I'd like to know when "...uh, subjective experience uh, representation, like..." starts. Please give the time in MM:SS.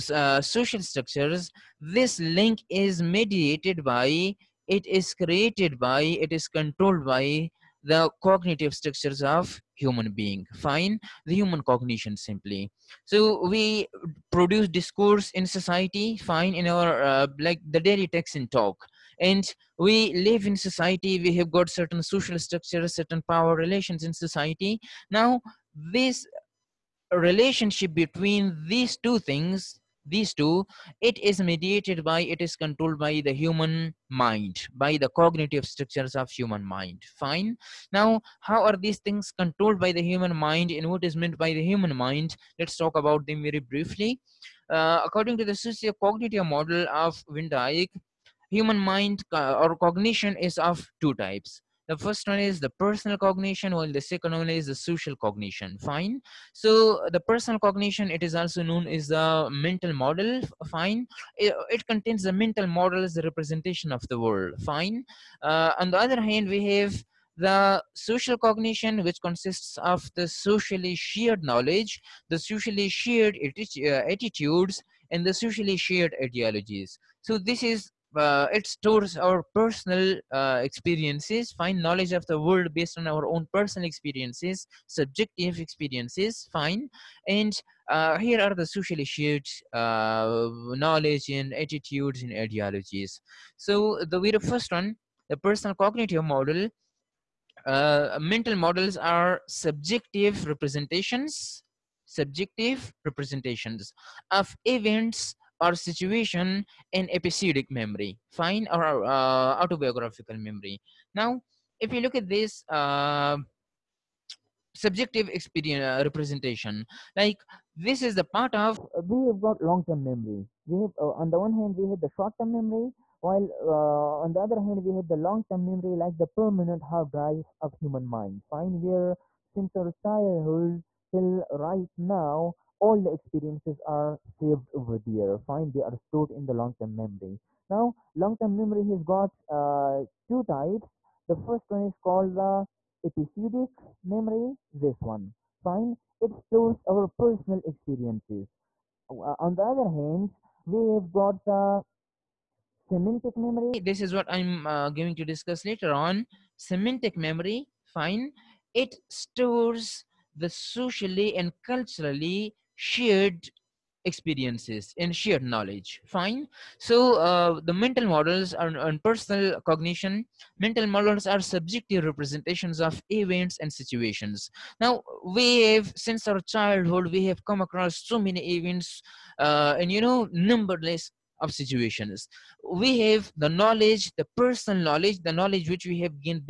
01:52.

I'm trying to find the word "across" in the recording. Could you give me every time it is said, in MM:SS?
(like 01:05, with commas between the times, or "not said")
02:57.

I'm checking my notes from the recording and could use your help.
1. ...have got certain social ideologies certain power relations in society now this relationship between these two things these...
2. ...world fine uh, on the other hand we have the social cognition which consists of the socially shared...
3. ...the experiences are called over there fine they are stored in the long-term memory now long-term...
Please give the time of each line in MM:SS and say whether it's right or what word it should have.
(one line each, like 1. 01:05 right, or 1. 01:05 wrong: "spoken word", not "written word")
1. 00:21 wrong: "structures", not "ideologies"
2. 01:04 right
3. 02:12 wrong: "saved", not "called".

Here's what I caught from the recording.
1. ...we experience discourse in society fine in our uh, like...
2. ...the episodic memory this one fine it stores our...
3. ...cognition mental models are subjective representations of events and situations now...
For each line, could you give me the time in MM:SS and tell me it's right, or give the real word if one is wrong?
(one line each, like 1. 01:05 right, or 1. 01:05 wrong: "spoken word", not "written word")
1. 00:13 wrong: "produce", not "experience"
2. 02:22 right
3. 02:49 right.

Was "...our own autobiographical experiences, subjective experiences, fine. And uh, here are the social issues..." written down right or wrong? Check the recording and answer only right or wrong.
wrong.